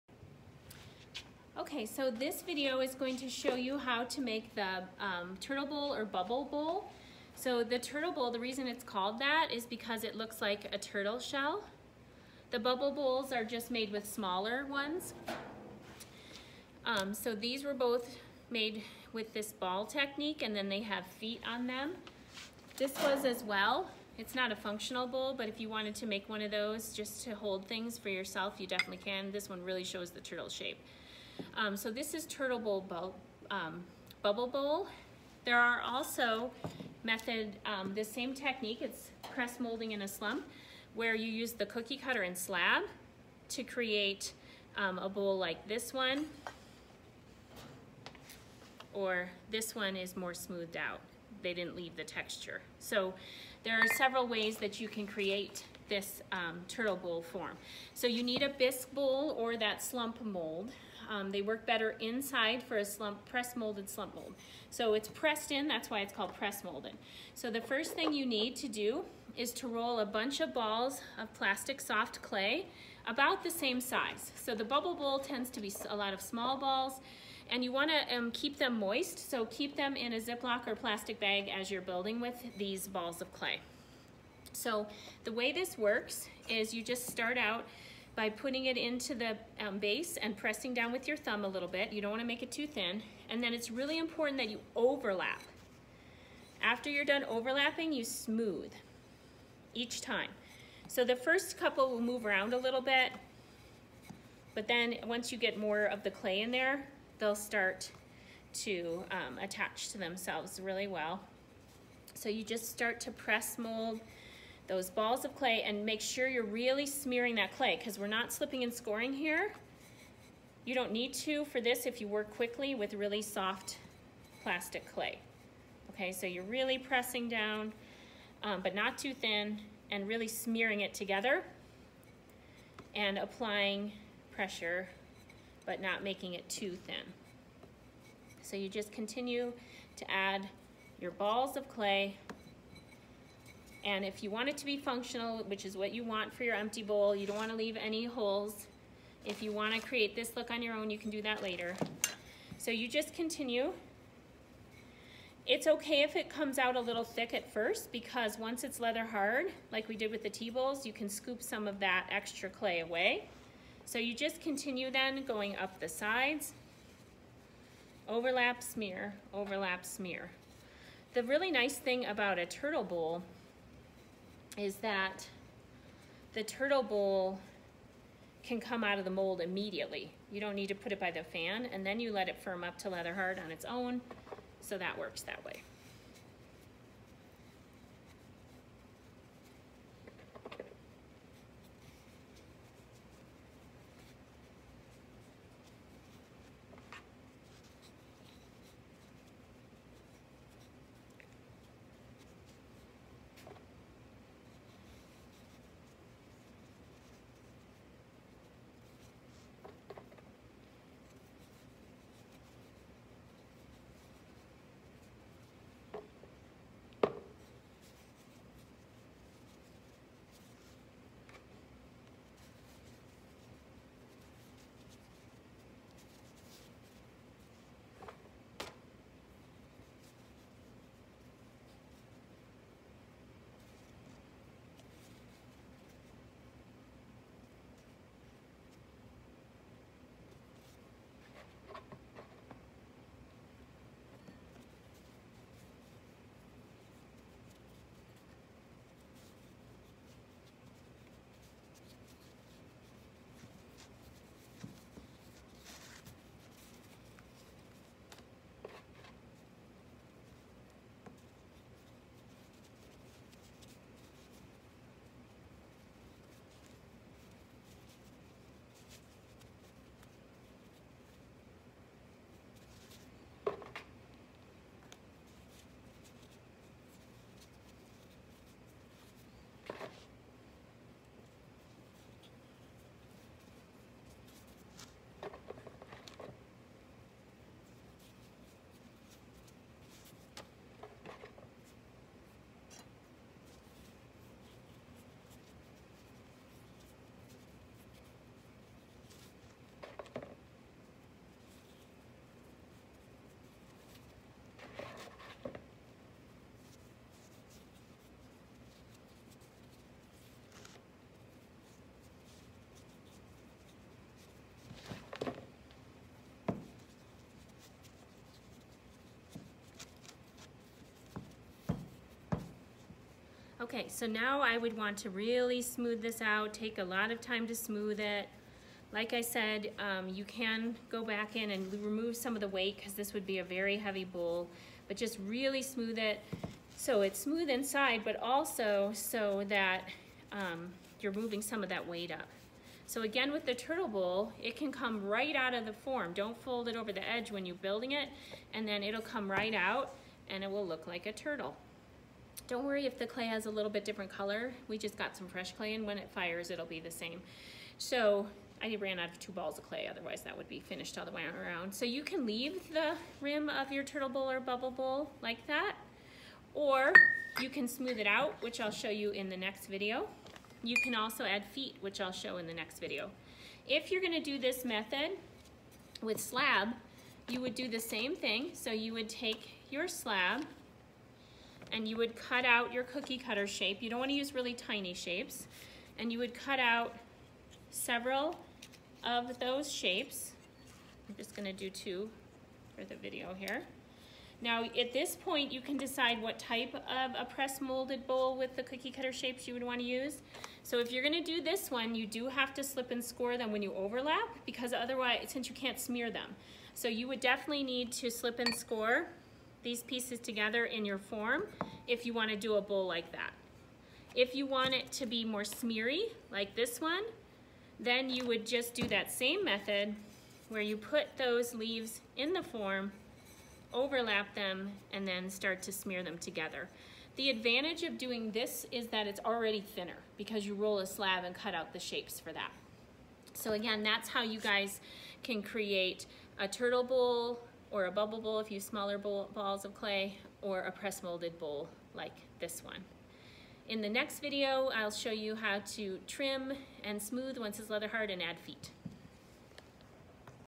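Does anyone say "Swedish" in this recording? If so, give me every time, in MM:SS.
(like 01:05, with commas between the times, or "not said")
not said.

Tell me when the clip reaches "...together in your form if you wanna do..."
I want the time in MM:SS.
06:50.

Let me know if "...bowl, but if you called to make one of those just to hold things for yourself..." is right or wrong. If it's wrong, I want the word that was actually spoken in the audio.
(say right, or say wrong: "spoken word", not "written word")
wrong: "wanted", not "called".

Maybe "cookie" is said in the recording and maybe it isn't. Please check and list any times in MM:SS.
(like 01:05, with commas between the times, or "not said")
00:41, 06:22, 06:38.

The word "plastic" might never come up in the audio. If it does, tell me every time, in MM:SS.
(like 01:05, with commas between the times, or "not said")
01:11, 01:20, 02:04.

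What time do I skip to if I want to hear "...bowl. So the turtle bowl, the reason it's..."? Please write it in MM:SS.
00:06.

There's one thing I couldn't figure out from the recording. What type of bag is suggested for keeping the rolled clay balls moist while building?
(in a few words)
Ziploc.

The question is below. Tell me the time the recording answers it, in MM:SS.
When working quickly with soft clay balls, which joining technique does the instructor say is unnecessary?
01:58.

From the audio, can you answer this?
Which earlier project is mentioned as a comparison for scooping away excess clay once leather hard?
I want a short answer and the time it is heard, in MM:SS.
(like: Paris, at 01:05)
Tea bowls, at 02:40.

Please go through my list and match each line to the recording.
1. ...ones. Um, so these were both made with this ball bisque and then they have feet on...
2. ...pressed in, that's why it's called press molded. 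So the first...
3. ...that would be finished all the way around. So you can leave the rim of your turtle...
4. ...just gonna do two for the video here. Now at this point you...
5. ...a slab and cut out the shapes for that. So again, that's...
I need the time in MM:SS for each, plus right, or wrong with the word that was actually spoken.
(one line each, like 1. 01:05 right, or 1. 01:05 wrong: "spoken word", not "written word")
1. 00:14 wrong: "technique", not "bisque"
2. 01:05 right
3. 06:00 right
4. 06:31 right
5. 07:10 right.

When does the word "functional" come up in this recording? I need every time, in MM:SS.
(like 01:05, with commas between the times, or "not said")
00:24, 02:24.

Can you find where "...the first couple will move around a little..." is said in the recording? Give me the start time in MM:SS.
01:41.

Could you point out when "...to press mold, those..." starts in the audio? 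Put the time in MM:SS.
01:53.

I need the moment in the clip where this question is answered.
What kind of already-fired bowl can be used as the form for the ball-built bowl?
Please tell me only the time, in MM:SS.
00:58.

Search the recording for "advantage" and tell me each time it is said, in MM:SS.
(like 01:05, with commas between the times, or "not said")
07:07.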